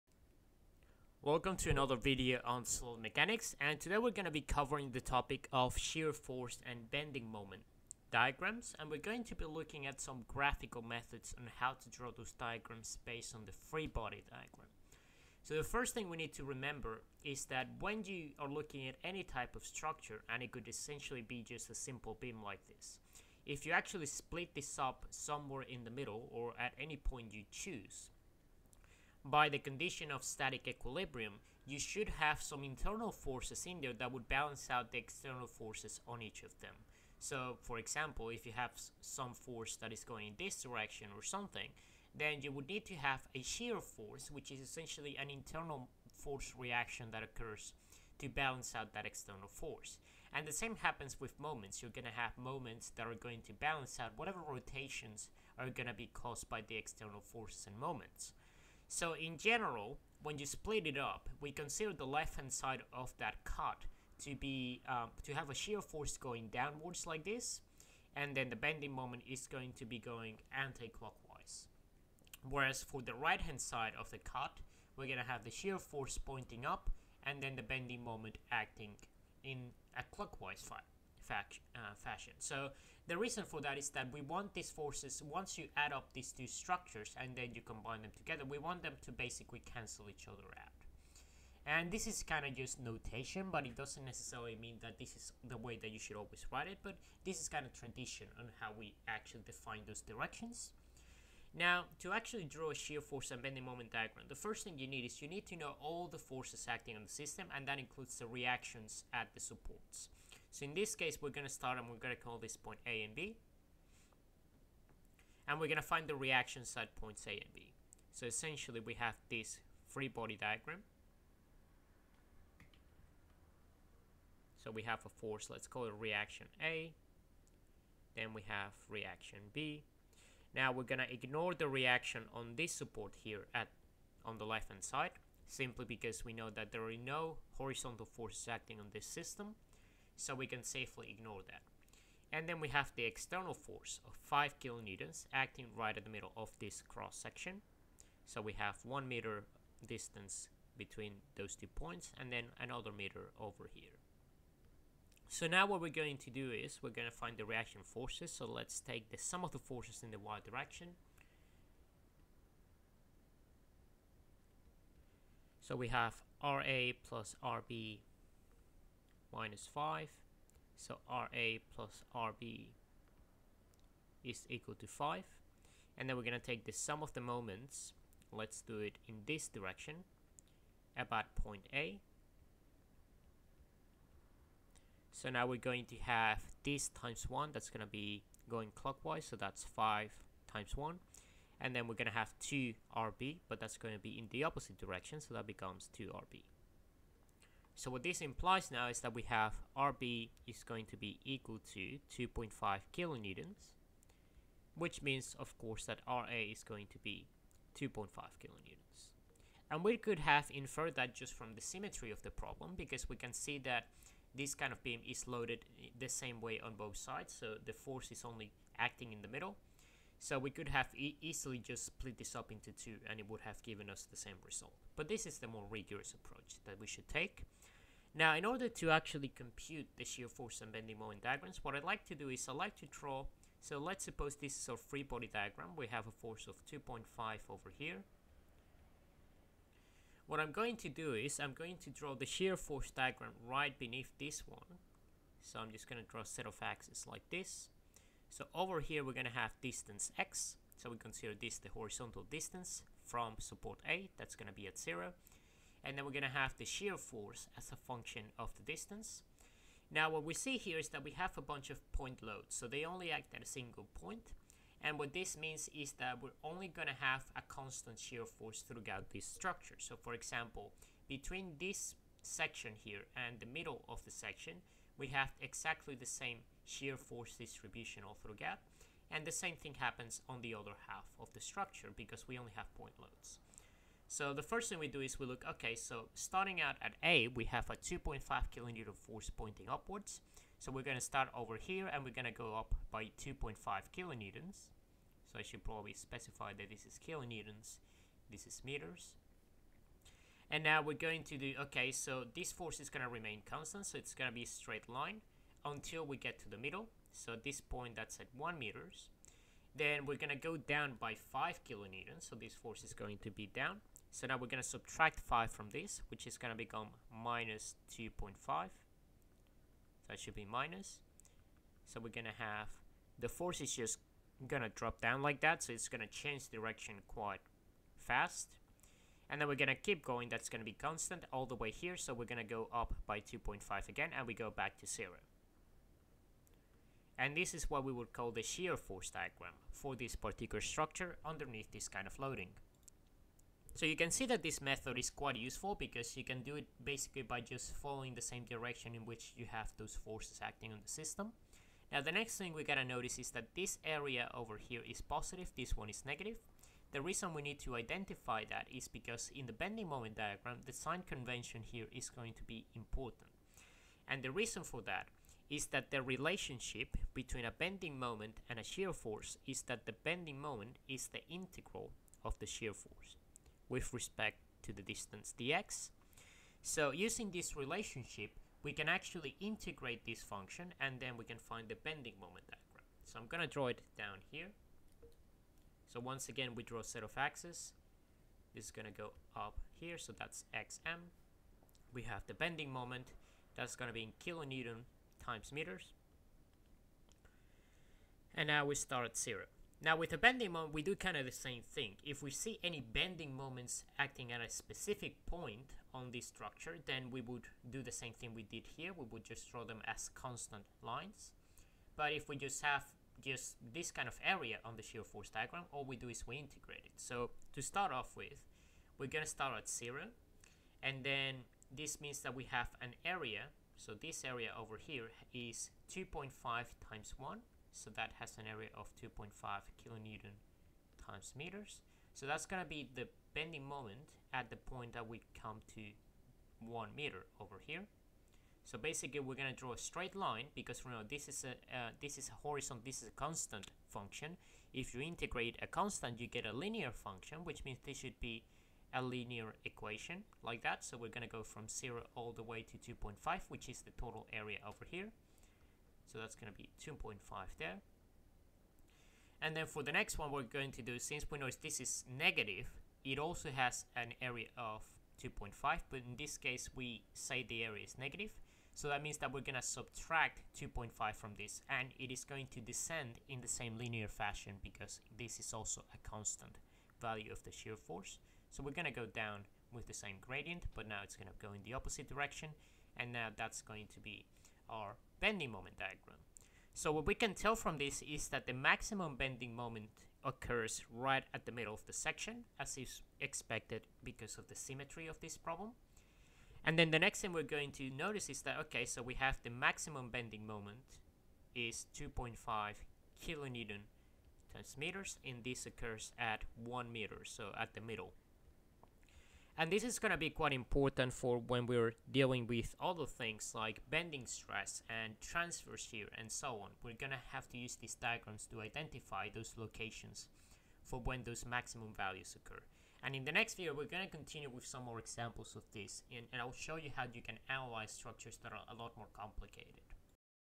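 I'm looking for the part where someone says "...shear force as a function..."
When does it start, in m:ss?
4:16.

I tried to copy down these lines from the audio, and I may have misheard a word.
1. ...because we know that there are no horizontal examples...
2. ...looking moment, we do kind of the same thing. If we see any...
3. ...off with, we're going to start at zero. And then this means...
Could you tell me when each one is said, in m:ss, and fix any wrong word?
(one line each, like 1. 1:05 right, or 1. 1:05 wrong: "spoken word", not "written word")
1. 2:15 wrong: "forces", not "examples"
2. 6:40 wrong: "bending", not "looking"
3. 6:57 right.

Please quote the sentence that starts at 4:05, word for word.
So I'm just going to draw a set of axes like this.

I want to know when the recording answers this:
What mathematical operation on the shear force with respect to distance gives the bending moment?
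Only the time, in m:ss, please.
6:11.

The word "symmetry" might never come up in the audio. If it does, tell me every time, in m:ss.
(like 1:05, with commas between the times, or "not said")
3:31, 8:14.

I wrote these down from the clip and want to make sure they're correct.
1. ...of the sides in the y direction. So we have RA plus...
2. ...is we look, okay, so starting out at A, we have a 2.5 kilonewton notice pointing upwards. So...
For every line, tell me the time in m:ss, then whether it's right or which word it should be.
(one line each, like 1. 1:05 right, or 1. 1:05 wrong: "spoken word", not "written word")
1. 2:39 wrong: "forces", not "sides"
2. 4:44 wrong: "force", not "notice".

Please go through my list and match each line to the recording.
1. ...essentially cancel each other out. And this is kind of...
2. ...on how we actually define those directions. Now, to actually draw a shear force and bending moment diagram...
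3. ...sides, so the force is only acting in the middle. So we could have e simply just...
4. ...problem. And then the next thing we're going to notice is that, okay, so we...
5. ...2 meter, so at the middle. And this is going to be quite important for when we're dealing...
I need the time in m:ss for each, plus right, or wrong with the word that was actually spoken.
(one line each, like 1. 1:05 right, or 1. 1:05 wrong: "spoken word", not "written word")
1. 1:29 wrong: "basically", not "essentially"
2. 1:38 right
3. 3:36 wrong: "easily", not "simply"
4. 8:15 right
5. 8:26 wrong: "1", not "2".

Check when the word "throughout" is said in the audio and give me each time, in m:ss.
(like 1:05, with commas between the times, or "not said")
4:28, 4:38.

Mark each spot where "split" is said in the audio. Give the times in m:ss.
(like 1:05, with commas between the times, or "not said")
0:24, 1:00, 3:41.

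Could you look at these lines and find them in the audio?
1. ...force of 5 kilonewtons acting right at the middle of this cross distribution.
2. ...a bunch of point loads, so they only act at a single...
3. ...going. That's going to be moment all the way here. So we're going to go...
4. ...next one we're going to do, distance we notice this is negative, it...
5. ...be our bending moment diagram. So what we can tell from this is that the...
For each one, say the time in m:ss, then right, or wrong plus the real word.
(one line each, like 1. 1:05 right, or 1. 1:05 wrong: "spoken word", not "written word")
1. 2:23 wrong: "section", not "distribution"
2. 4:21 right
3. 5:30 wrong: "constant", not "moment"
4. 7:39 wrong: "since", not "distance"
5. 8:03 right.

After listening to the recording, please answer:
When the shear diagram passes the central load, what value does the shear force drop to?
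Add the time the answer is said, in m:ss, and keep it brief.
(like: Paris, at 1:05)
-2.5, at 5:17.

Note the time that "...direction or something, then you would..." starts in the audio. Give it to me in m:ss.
0:40.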